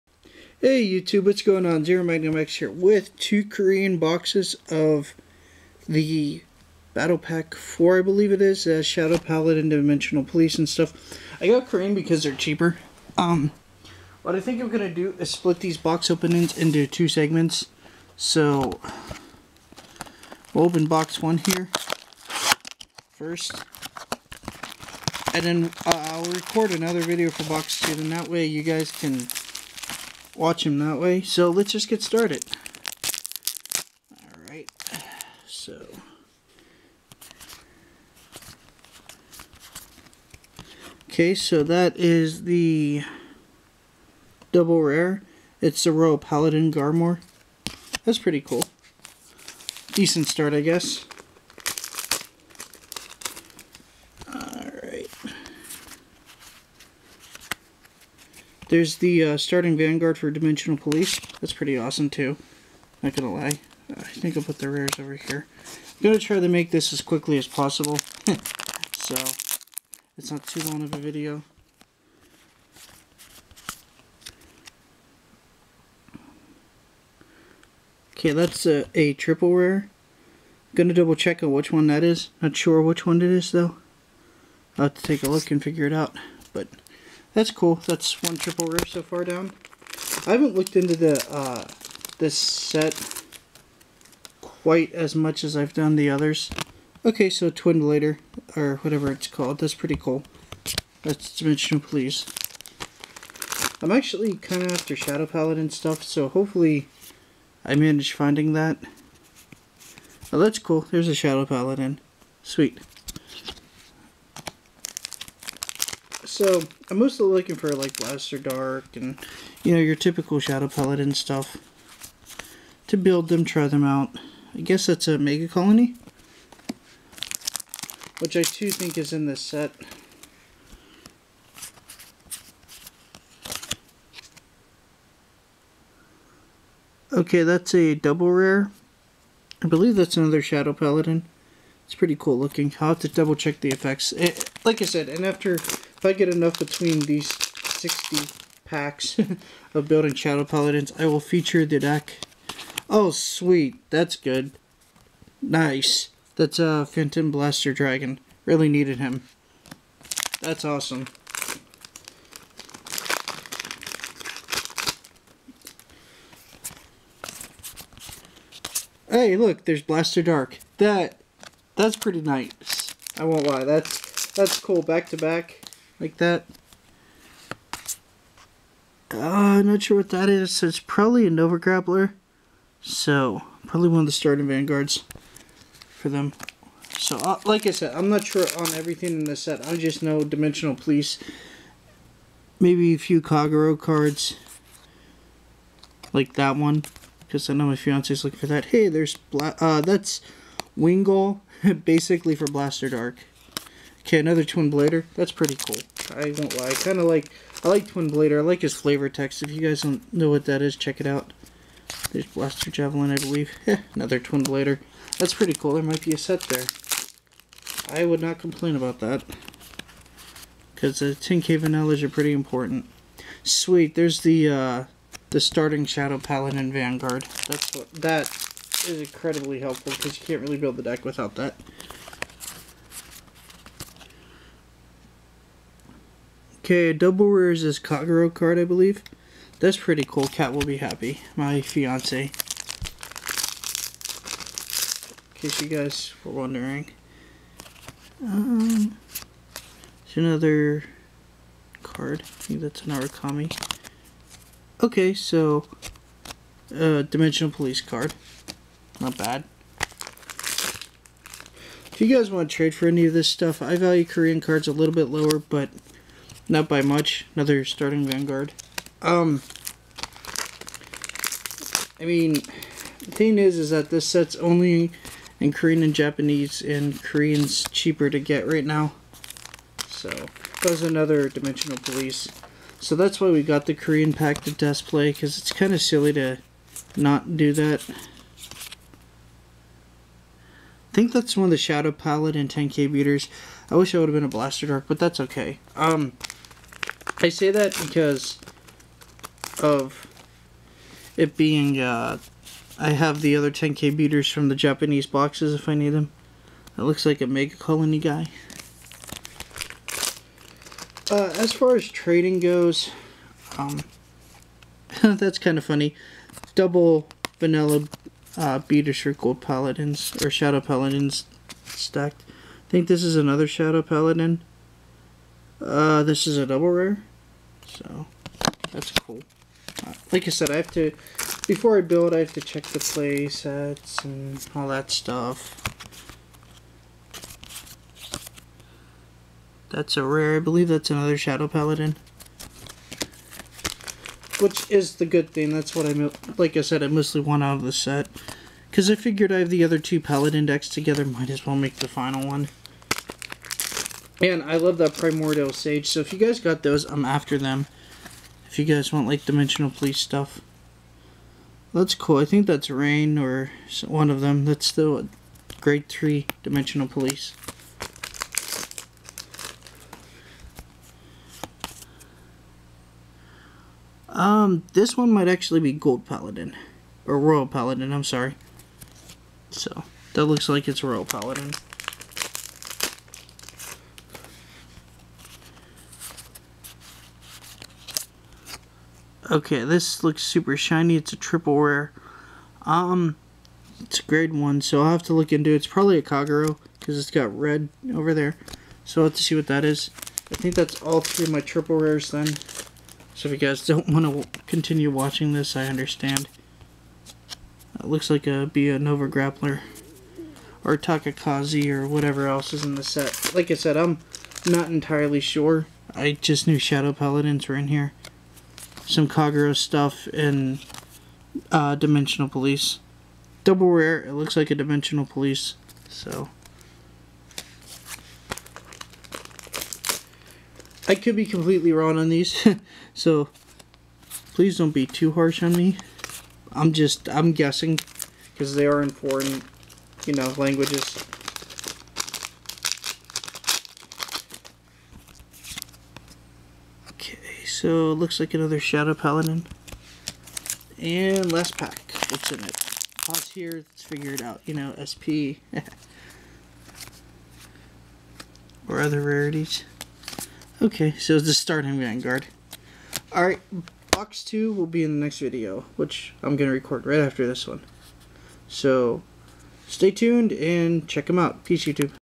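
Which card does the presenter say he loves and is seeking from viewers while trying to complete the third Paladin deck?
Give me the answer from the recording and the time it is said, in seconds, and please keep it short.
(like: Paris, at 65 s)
Primordial Sage, at 354 s.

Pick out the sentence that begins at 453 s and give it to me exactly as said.
Pause here, let's figure it out.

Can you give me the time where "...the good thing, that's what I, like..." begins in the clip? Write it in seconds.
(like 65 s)
344 s.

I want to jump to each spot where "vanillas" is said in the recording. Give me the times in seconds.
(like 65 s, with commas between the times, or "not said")
221 s, 317 s.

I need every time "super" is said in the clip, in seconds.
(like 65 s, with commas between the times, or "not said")
390 s.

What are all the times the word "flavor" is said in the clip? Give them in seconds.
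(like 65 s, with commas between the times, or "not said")
208 s.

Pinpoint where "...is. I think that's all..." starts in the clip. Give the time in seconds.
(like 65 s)
399 s.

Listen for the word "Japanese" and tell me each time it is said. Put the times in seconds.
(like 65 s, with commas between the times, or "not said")
275 s, 304 s.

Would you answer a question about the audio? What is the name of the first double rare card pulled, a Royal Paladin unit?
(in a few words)
Garmore.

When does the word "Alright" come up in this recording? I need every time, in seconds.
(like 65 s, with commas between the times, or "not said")
34 s, 463 s.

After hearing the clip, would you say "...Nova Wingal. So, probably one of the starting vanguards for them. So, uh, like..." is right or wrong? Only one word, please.
wrong.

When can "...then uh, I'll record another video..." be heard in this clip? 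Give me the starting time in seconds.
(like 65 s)
25 s.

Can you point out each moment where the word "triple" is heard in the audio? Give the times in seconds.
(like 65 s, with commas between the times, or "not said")
79 s, 88 s, 391 s, 401 s.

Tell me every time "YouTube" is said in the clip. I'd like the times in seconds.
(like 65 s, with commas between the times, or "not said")
0 s, 471 s.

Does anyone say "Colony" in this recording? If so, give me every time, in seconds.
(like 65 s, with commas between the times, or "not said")
125 s, 307 s.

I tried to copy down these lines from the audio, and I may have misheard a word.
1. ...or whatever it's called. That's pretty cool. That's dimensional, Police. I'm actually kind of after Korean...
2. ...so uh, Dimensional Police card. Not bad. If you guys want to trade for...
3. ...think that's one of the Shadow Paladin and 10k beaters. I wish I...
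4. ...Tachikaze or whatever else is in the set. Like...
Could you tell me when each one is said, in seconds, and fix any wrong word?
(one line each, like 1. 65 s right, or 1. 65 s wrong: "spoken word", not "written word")
1. 98 s wrong: "Shadow", not "Korean"
2. 255 s right
3. 290 s right
4. 410 s right.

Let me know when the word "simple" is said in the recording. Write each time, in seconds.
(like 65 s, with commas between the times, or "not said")
not said.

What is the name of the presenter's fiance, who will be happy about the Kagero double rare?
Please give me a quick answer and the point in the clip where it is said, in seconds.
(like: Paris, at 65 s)
Cat, at 240 s.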